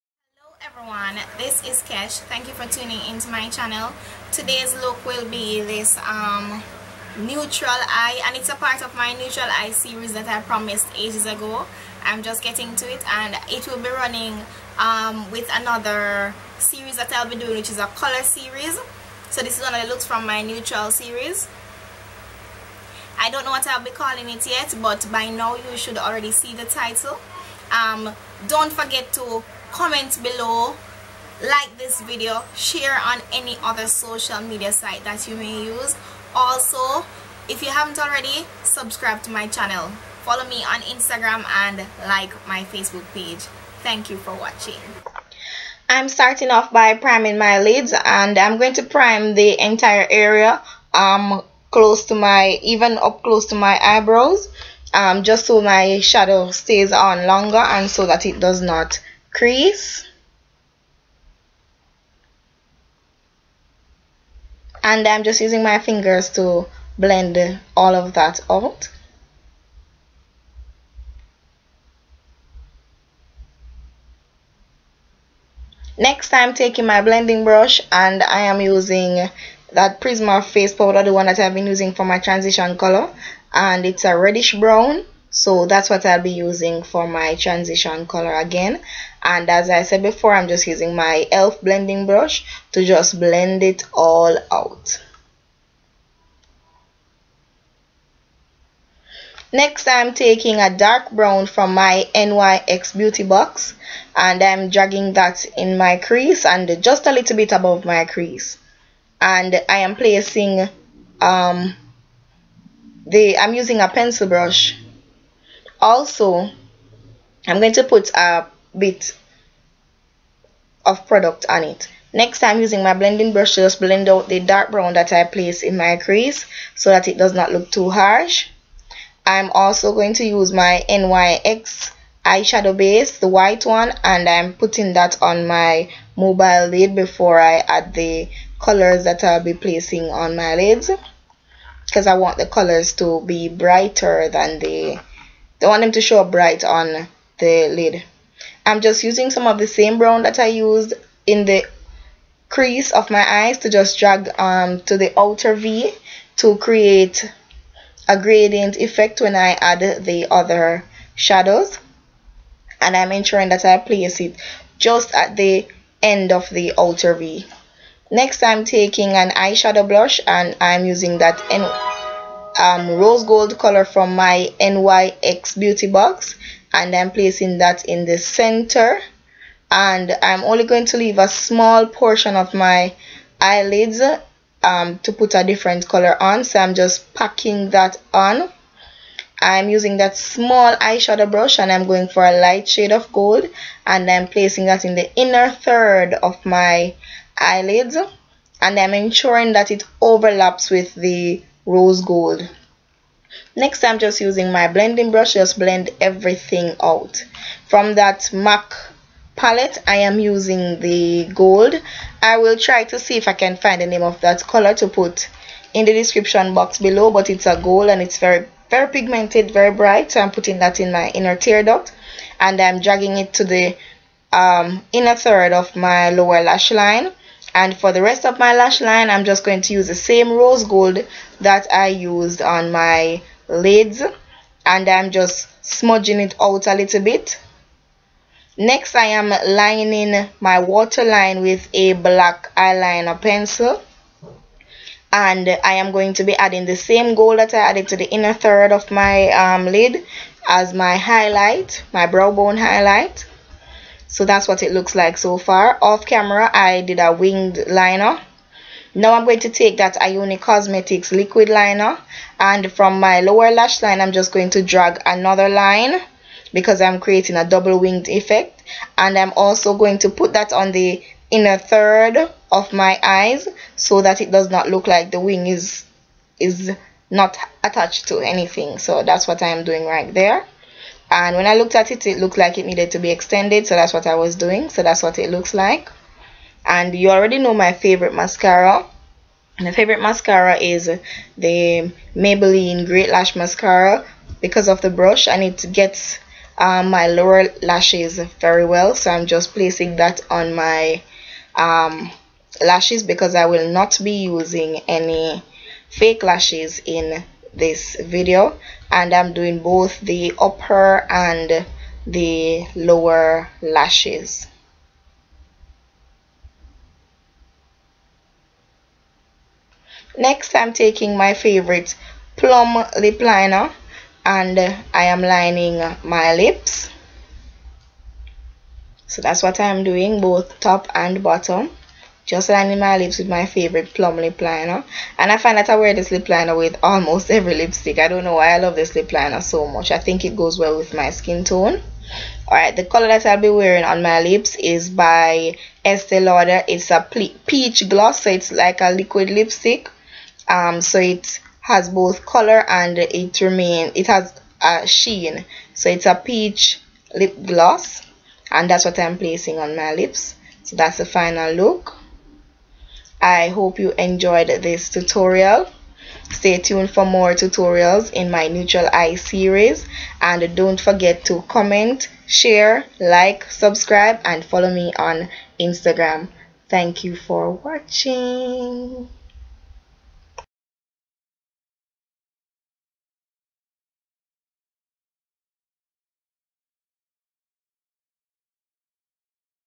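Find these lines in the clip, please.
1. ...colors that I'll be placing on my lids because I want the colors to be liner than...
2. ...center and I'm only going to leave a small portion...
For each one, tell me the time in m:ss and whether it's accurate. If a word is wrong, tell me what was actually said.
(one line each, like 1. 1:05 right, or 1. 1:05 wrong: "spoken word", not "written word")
1. 2:18 wrong: "brighter", not "liner"
2. 2:58 right.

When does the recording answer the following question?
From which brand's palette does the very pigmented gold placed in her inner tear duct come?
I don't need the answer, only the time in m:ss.
3:28.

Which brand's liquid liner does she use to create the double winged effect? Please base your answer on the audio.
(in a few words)
Ioni Cosmetics.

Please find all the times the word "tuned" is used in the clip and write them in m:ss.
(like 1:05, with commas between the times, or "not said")
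6:06.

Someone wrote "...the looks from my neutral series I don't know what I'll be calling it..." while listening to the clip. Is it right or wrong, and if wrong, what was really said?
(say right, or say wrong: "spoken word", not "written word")
right.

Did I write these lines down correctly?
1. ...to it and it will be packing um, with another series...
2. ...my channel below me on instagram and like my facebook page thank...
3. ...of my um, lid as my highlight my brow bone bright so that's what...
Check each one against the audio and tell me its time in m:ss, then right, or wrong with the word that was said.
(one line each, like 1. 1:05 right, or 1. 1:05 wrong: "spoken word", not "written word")
1. 0:12 wrong: "running", not "packing"
2. 0:39 wrong: "follow", not "below"
3. 4:08 wrong: "highlight", not "bright".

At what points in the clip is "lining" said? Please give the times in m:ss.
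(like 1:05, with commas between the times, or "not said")
3:59, 5:25, 5:32.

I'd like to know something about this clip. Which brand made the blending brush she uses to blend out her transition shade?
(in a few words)
elf.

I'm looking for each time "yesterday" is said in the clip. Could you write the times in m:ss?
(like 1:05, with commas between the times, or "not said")
not said.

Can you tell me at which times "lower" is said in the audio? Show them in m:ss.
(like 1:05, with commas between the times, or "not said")
3:46, 4:23, 4:57, 5:12.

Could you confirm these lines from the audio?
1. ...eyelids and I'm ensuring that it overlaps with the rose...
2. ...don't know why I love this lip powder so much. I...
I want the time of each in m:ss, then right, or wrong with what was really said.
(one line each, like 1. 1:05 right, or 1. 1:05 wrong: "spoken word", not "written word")
1. 3:17 right
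2. 5:38 wrong: "liner", not "powder".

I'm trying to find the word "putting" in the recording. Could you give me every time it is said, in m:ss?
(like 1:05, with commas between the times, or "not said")
2:14, 3:40.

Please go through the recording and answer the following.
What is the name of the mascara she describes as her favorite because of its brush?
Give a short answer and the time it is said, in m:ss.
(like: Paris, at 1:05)
Maybelline Great Lash, at 4:52.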